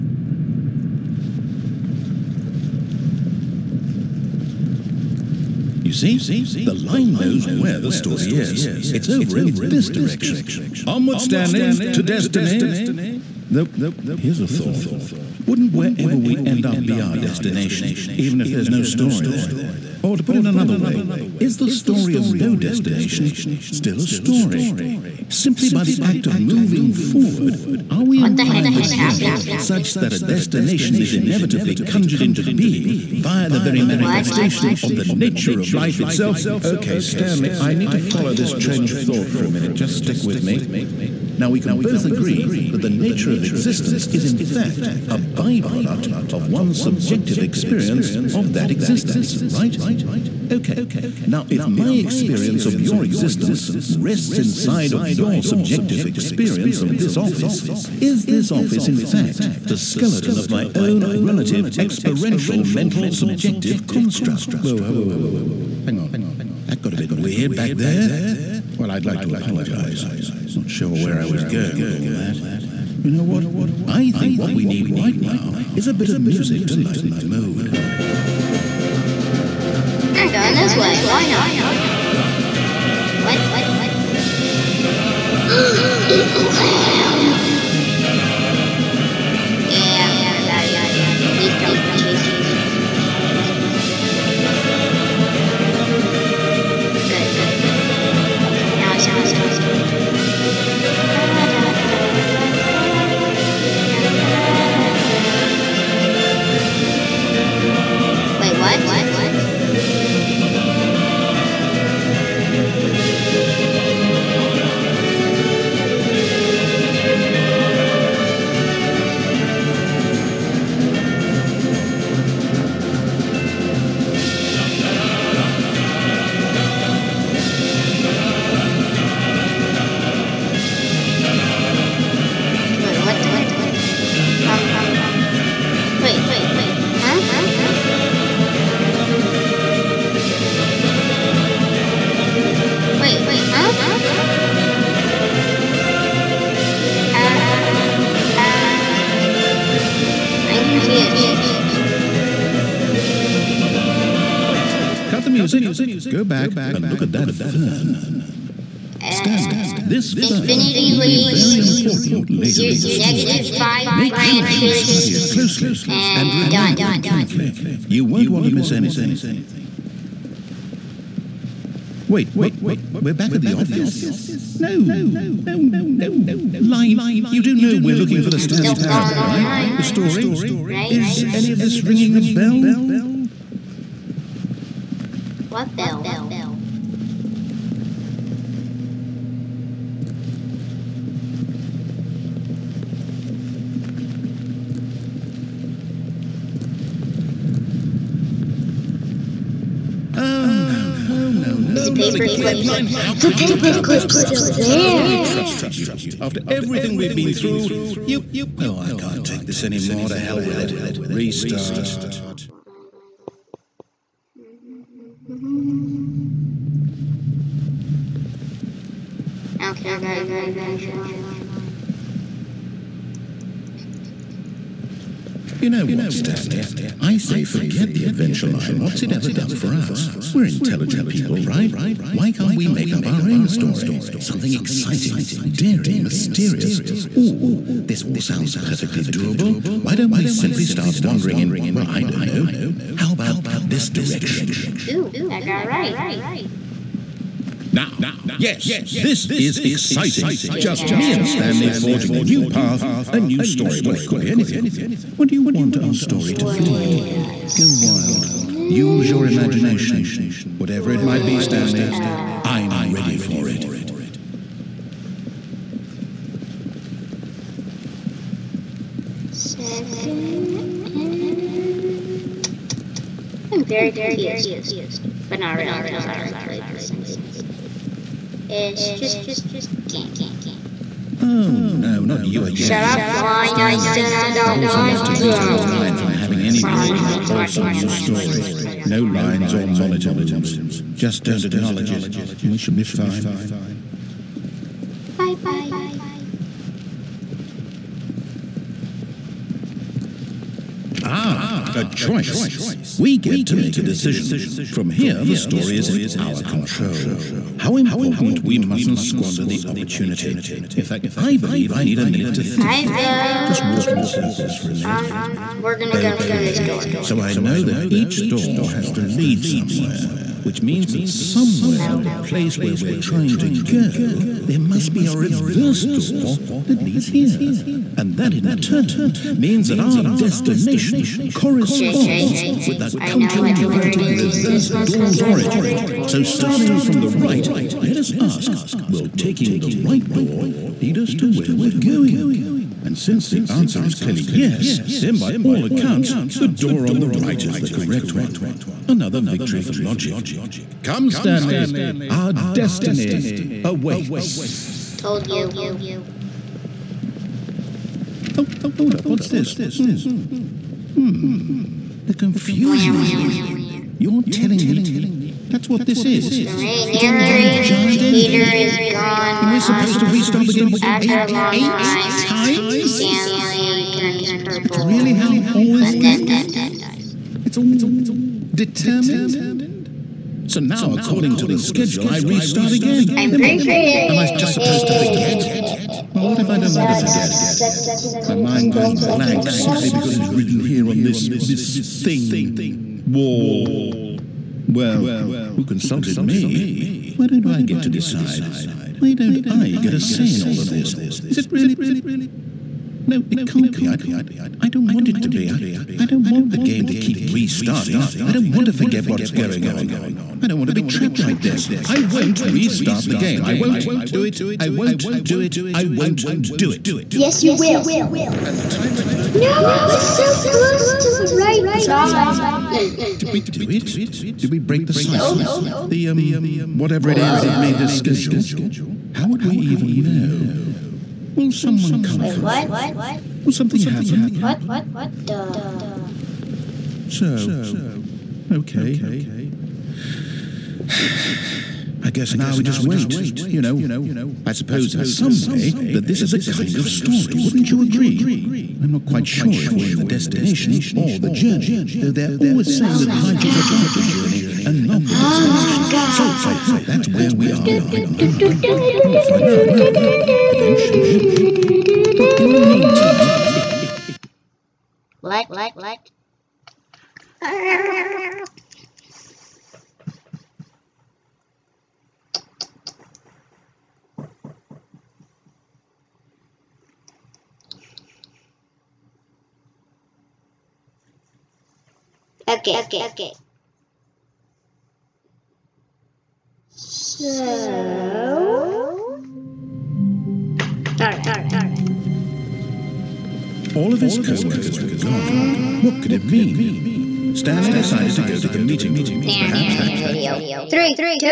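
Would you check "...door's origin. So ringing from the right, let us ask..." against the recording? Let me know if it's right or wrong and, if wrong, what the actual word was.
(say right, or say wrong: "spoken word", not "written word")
wrong: "starting", not "ringing".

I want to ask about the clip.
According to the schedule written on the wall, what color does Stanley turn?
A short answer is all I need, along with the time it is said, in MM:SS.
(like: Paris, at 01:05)
Purple, at 06:14.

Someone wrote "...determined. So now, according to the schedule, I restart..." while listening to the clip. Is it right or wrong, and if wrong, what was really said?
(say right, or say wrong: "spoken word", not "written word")
right.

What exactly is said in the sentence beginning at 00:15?
Wouldn't wherever we end up be our destination, even if there's no story there?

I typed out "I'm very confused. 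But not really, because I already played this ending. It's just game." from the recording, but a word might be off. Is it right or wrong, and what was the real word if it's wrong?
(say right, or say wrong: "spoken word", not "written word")
right.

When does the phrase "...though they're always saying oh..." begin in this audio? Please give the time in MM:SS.
07:31.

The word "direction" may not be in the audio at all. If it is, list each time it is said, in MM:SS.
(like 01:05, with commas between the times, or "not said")
00:09, 04:03.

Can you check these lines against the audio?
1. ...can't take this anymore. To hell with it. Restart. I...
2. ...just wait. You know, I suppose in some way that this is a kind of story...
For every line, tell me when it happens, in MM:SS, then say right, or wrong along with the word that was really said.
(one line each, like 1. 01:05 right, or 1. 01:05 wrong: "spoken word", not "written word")
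1. 03:28 right
2. 07:22 right.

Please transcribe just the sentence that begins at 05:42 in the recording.
And since the answer is clearly yes, then by all accounts, the door on the right is the correct one.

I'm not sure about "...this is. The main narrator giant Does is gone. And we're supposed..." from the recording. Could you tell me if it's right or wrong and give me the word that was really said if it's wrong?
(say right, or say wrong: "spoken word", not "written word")
wrong: "Peter", not "Does".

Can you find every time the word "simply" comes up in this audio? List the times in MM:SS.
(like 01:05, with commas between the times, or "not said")
00:25, 04:00, 06:29.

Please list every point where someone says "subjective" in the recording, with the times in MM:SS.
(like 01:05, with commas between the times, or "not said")
00:46, 00:55, 01:03.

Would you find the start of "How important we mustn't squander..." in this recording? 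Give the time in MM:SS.
05:07.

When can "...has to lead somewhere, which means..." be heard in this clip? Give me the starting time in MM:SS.
05:18.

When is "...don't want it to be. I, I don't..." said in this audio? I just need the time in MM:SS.
06:44.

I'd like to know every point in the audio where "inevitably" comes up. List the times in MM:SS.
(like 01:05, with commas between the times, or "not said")
00:31.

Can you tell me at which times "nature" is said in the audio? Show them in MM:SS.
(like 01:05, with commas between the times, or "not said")
00:35, 00:42.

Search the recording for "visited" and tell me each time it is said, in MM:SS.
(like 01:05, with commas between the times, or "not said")
not said.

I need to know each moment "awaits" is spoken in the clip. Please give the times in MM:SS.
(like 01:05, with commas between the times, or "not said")
05:53.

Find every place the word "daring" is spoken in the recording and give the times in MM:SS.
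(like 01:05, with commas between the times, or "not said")
03:55.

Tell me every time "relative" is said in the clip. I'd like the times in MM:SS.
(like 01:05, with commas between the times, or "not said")
01:01.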